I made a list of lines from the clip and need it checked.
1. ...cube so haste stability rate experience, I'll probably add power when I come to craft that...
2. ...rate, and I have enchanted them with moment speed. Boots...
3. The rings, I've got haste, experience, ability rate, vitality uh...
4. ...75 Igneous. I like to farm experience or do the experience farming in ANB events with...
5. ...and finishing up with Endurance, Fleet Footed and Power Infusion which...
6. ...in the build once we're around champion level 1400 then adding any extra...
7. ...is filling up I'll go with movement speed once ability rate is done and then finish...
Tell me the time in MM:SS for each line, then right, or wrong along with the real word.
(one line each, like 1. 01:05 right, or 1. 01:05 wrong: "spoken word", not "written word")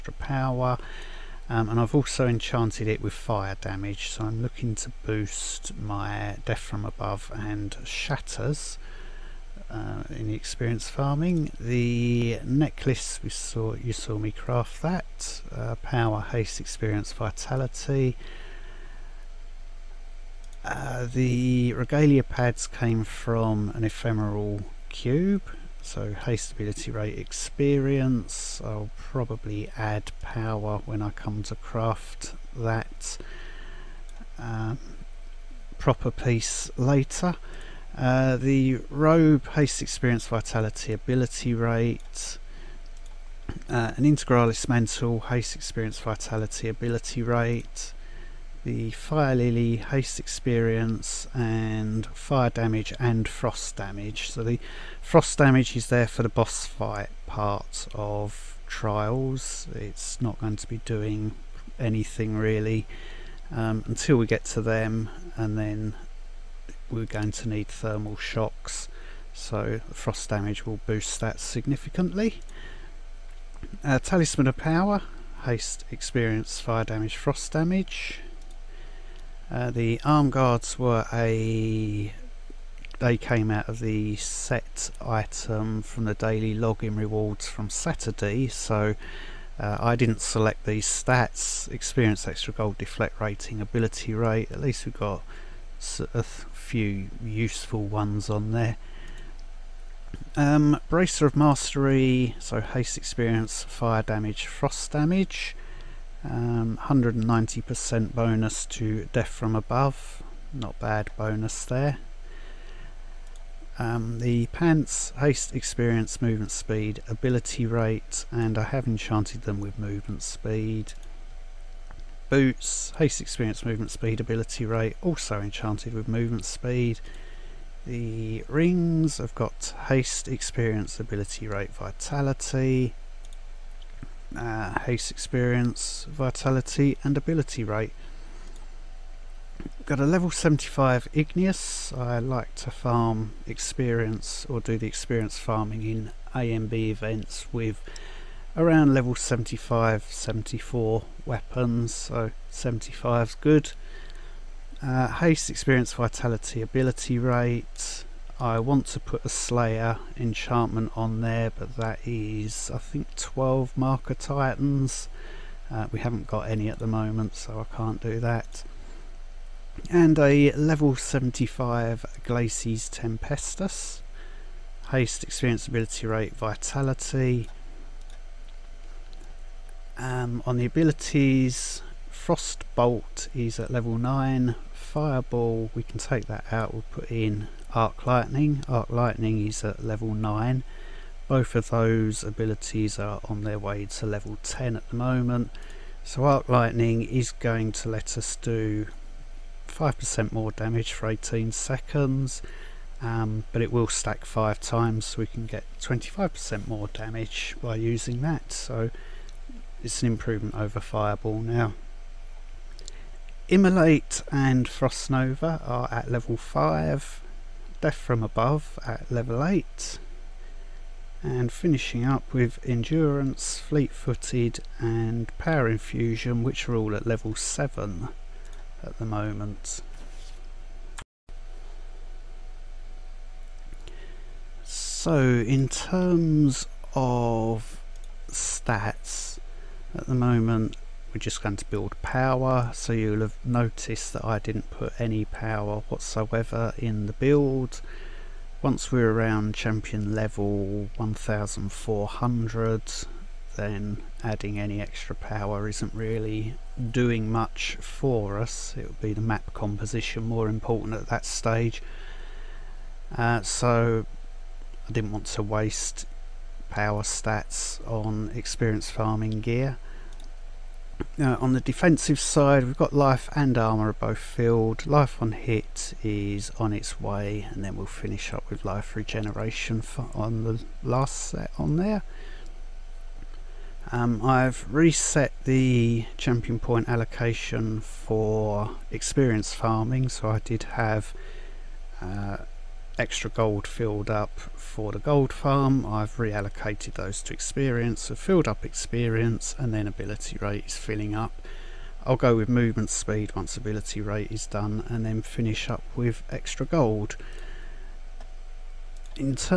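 1. 00:24 right
2. 01:57 wrong: "movement", not "moment"
3. 02:07 right
4. 02:20 right
5. 03:41 right
6. 04:06 right
7. 05:00 right.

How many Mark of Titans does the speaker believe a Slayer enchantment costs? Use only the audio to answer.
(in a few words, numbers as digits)
12.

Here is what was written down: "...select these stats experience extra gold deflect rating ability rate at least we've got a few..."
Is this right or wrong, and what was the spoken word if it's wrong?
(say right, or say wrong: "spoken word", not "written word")
right.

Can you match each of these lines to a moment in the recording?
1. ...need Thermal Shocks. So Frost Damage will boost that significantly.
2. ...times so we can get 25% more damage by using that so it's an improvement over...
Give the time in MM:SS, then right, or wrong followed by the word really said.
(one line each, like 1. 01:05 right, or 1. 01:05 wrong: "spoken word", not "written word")
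1. 01:07 right
2. 03:24 right.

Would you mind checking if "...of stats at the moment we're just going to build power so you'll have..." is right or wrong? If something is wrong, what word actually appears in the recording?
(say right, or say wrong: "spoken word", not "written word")
right.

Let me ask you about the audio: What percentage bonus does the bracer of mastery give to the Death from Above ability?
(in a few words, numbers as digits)
190%.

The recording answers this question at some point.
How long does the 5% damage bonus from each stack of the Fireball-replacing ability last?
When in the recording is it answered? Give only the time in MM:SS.
03:21.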